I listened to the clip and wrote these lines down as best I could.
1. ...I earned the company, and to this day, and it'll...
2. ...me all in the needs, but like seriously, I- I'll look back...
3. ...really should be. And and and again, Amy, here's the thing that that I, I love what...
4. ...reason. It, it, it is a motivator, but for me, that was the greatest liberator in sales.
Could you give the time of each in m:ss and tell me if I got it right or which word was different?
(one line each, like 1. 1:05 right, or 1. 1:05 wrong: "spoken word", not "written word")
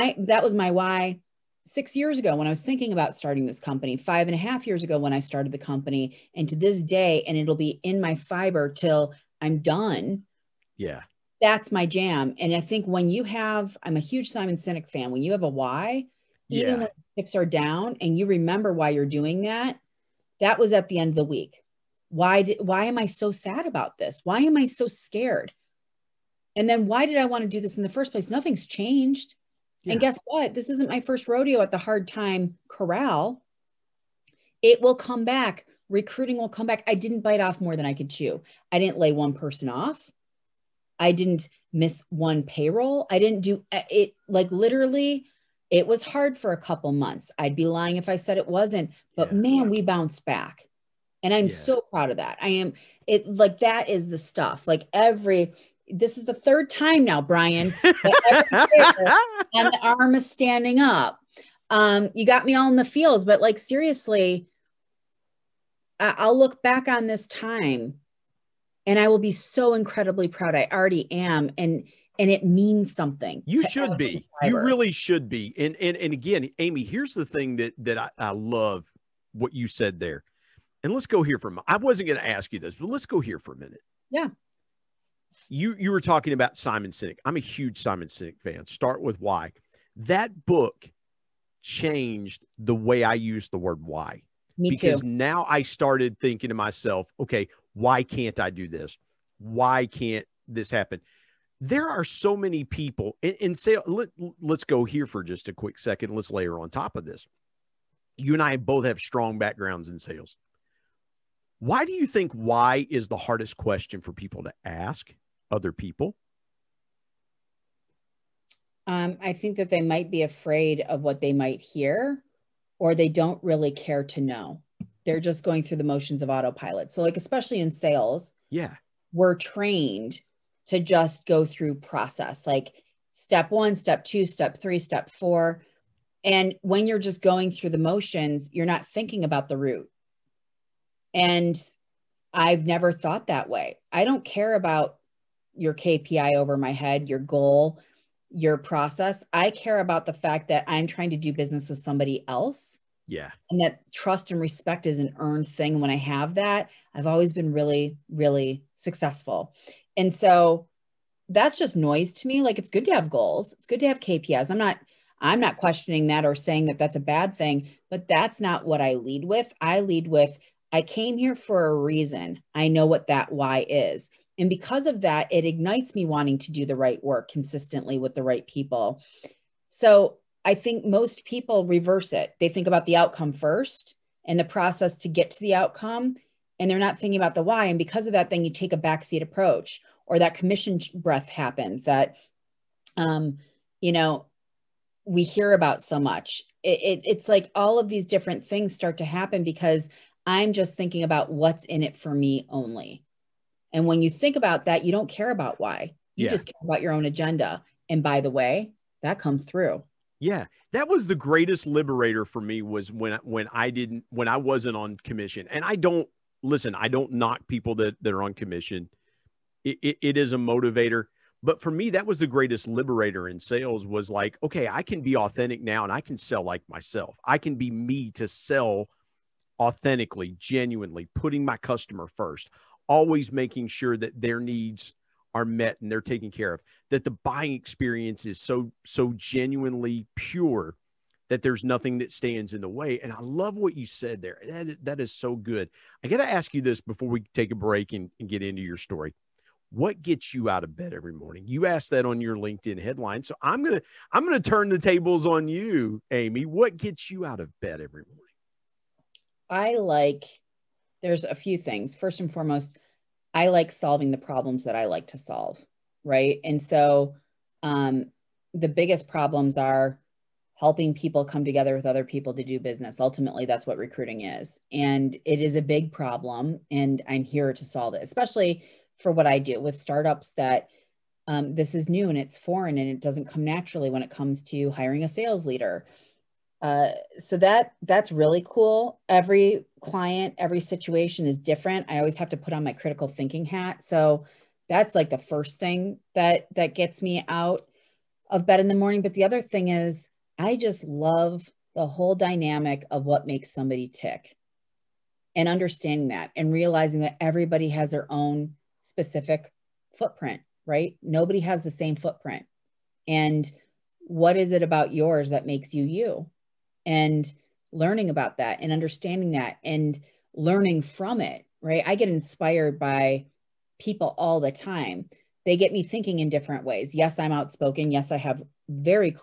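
1. 0:05 wrong: "started", not "earned"
2. 1:02 wrong: "fields", not "needs"
3. 1:14 right
4. 3:38 wrong: "commission", not "reason".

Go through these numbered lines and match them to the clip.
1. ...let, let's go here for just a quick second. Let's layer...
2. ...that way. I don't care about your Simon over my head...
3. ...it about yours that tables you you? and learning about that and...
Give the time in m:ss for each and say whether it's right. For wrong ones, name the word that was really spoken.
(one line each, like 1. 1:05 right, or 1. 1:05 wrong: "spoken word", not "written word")
1. 1:43 right
2. 2:23 wrong: "KPI", not "Simon"
3. 5:14 wrong: "makes", not "tables".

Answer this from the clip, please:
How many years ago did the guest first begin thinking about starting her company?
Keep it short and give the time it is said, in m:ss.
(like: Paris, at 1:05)
6, at 0:01.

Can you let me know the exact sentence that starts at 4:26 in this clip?
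And so um, the biggest problems are helping people come together with other people to do business.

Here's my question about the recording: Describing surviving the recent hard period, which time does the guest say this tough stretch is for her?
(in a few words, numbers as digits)
third.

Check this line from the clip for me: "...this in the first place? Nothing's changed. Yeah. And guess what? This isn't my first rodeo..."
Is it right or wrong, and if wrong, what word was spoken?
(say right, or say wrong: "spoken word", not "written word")
right.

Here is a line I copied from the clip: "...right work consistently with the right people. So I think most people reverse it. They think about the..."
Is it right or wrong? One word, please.
right.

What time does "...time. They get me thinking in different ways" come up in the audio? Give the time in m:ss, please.
5:24.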